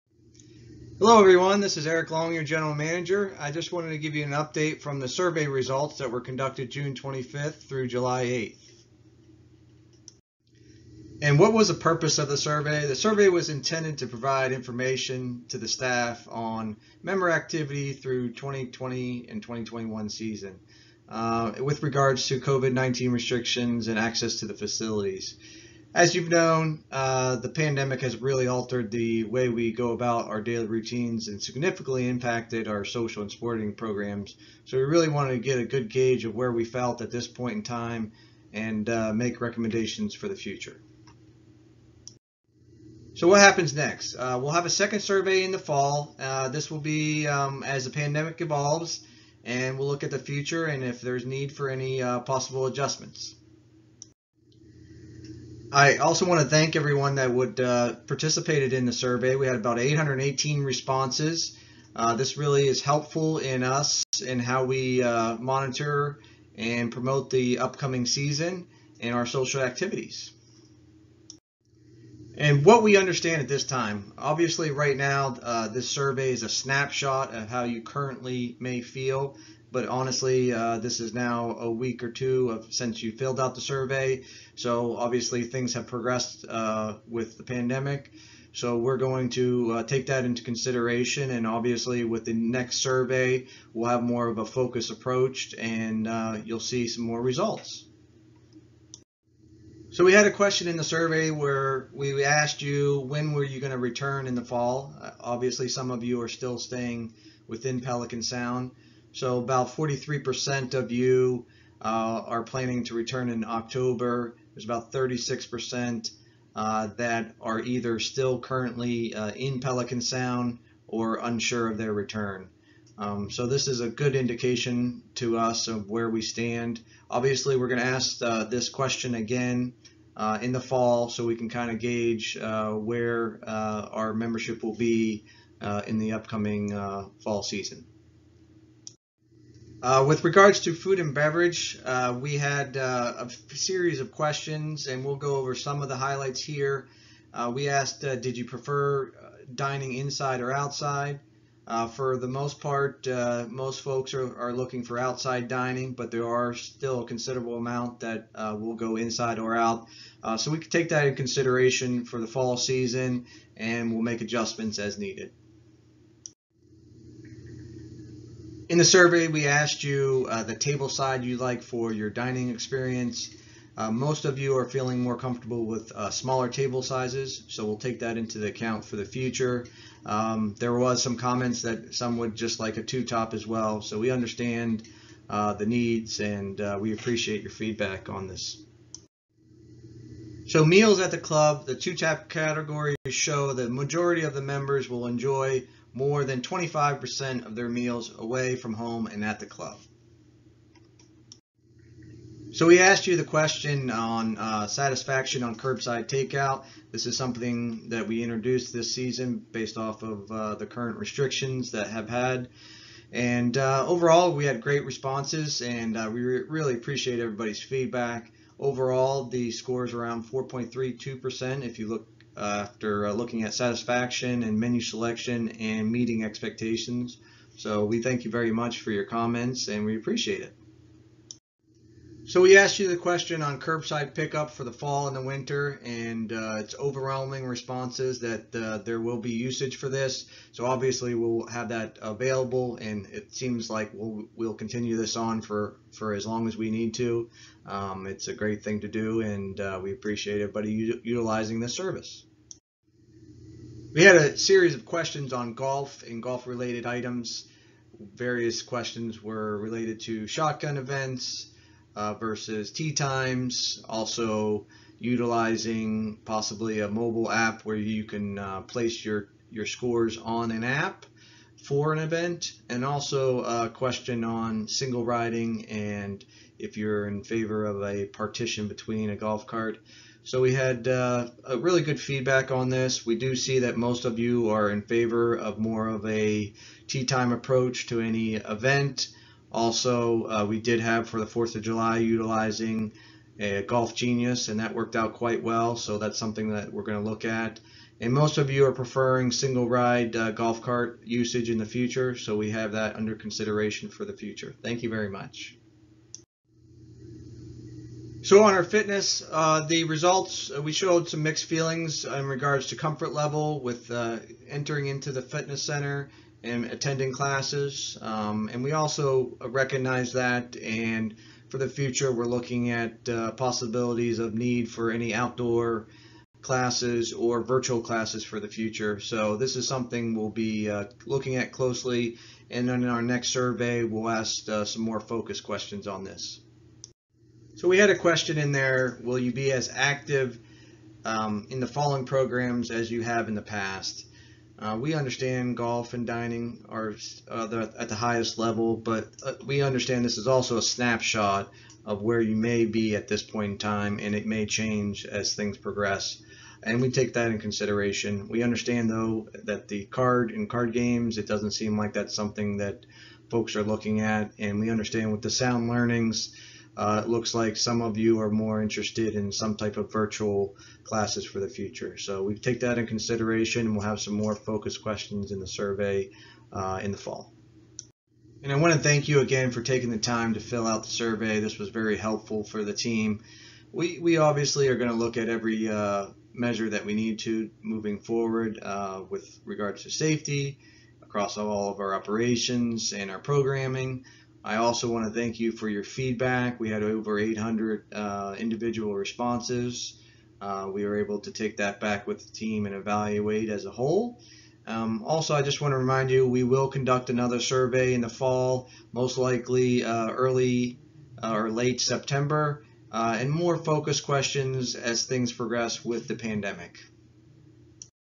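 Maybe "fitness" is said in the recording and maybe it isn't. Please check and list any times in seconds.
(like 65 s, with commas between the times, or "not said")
308 s, 315 s.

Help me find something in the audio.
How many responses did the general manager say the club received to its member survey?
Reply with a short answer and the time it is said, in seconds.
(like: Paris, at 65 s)
818, at 59 s.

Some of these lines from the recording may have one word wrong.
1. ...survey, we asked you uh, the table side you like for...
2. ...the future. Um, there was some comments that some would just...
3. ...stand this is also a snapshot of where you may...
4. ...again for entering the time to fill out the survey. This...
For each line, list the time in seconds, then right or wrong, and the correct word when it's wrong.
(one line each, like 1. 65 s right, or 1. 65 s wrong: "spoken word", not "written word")
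1. 168 s right
2. 178 s right
3. 349 s wrong: "understand", not "stand"
4. 379 s wrong: "taking", not "entering".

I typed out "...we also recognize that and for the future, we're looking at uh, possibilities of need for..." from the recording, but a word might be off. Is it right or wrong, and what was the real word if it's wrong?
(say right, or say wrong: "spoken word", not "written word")
right.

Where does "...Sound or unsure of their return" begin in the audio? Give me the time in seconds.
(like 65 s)
119 s.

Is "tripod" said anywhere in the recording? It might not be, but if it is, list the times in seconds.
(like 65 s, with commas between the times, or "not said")
not said.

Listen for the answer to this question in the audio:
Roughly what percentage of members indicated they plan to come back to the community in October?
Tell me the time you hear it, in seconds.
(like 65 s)
109 s.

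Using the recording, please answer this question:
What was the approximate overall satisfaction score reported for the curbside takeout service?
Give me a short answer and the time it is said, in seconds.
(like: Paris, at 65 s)
4.32, at 220 s.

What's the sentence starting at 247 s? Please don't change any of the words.
Um, it's a great thing to do, and uh, we appreciate everybody utilizing this service.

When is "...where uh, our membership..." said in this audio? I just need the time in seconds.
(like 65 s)
132 s.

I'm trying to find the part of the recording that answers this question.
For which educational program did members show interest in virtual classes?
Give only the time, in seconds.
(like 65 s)
365 s.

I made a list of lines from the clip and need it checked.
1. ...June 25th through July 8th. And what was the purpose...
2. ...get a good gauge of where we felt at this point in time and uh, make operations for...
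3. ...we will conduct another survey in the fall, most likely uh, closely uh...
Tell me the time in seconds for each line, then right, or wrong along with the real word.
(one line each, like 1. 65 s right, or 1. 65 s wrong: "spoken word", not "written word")
1. 6 s right
2. 35 s wrong: "recommendations", not "operations"
3. 406 s wrong: "early", not "closely".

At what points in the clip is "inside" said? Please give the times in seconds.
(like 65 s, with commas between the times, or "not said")
149 s, 158 s.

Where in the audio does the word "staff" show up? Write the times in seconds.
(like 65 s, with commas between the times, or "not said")
15 s.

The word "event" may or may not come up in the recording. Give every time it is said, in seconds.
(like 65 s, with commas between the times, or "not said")
260 s, 271 s, 288 s.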